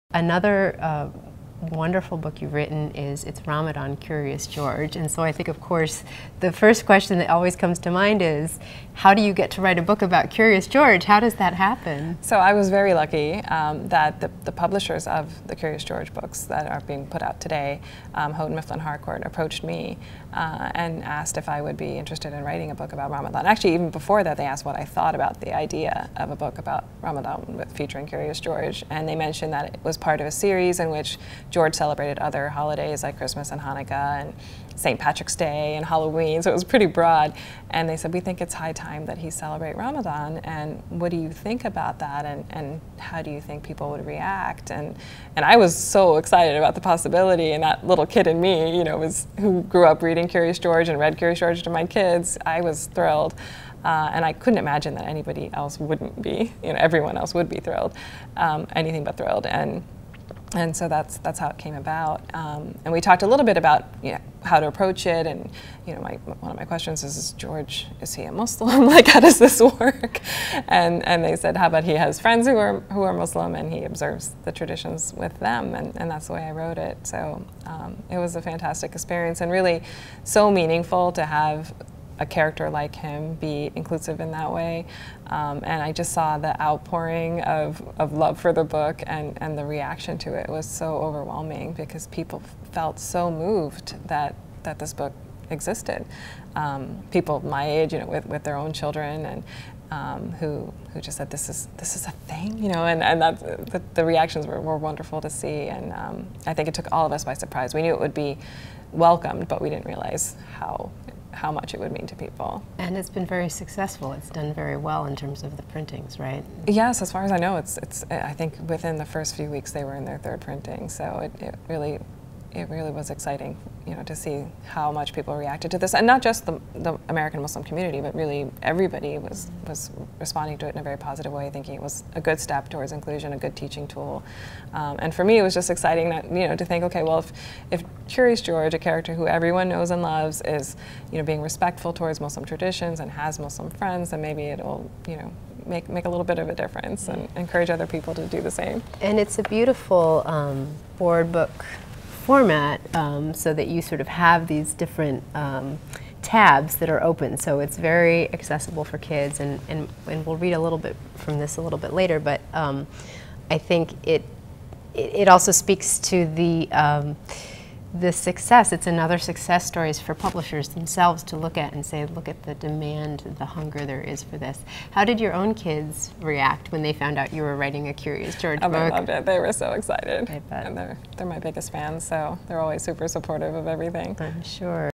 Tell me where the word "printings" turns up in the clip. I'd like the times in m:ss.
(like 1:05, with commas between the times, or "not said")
1:55, 2:00.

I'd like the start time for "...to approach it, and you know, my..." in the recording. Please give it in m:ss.
1:04.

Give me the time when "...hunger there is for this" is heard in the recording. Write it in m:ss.
2:53.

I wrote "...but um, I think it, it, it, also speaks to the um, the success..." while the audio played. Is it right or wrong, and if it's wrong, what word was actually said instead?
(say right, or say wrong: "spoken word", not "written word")
right.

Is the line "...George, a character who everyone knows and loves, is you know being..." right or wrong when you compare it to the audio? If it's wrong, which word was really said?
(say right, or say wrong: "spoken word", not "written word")
right.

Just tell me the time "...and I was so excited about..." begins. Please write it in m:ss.
0:45.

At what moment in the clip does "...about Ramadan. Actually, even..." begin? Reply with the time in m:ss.
0:22.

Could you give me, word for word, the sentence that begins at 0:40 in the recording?
And what do you think about that?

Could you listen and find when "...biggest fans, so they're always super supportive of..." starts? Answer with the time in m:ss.
3:01.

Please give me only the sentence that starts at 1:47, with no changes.
We knew it would be welcomed, but we didn't realize how how much it would mean to people.